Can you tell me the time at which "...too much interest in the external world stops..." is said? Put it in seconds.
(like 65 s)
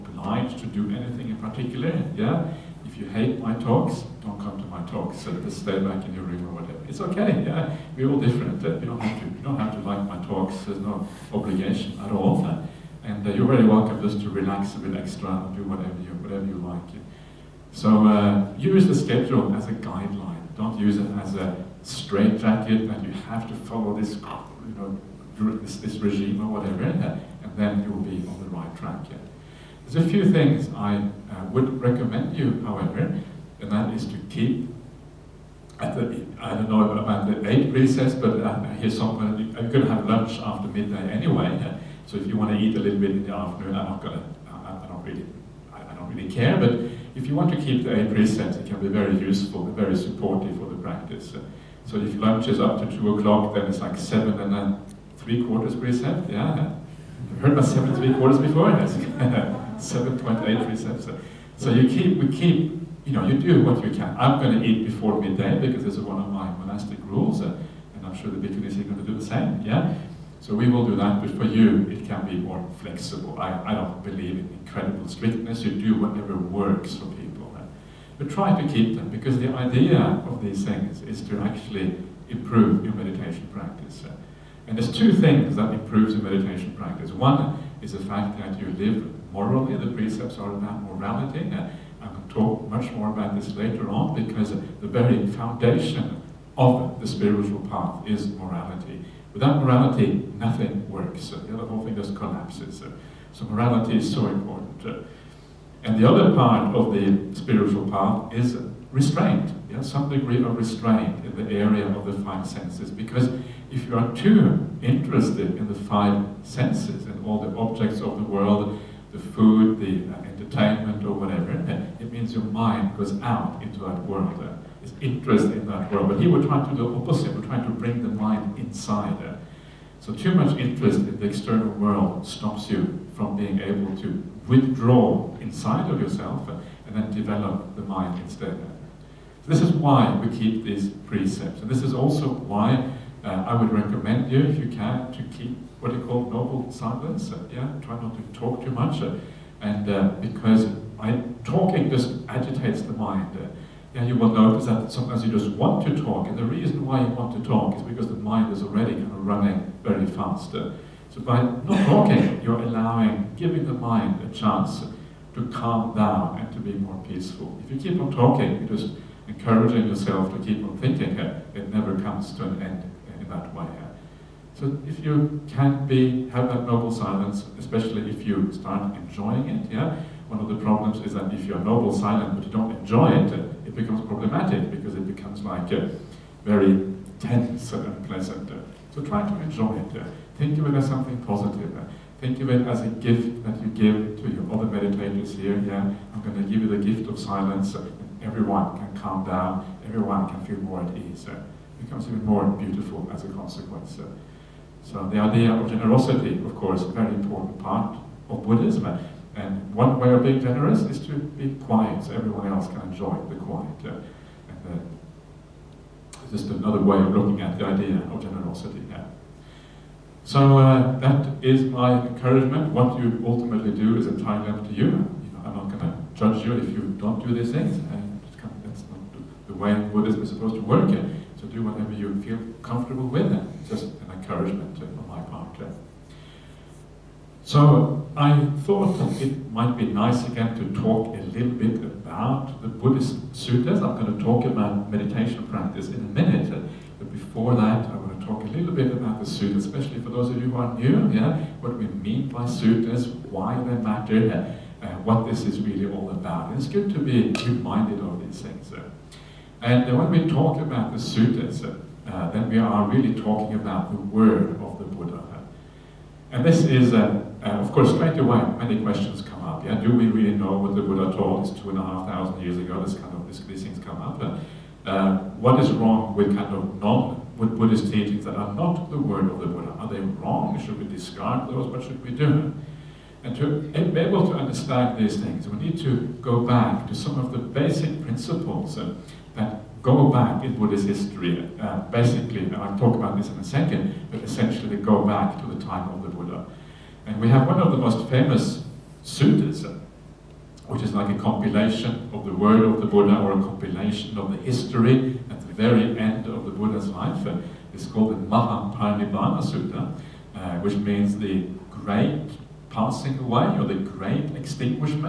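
130 s.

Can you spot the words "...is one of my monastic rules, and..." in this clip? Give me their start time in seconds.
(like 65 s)
65 s.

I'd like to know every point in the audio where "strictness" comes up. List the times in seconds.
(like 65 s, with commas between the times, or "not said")
75 s.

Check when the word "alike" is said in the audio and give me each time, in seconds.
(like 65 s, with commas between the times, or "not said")
not said.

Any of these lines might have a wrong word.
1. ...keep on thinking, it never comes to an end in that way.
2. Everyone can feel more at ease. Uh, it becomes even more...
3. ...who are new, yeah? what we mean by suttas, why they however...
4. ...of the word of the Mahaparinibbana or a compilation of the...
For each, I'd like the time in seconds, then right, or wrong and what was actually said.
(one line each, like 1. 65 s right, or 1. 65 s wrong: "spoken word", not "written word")
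1. 170 s right
2. 199 s right
3. 250 s wrong: "matter", not "however"
4. 302 s wrong: "Buddha", not "Mahaparinibbana".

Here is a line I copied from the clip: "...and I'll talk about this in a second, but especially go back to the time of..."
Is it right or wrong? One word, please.
wrong.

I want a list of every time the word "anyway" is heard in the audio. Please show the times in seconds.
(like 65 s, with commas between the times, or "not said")
41 s.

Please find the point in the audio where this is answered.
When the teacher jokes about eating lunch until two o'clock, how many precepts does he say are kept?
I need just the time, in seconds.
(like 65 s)
53 s.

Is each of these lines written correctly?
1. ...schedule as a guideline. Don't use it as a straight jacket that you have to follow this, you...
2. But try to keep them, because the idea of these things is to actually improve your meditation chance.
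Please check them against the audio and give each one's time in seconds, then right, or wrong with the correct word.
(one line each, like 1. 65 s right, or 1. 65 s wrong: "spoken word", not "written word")
1. 18 s right
2. 78 s wrong: "practice", not "chance".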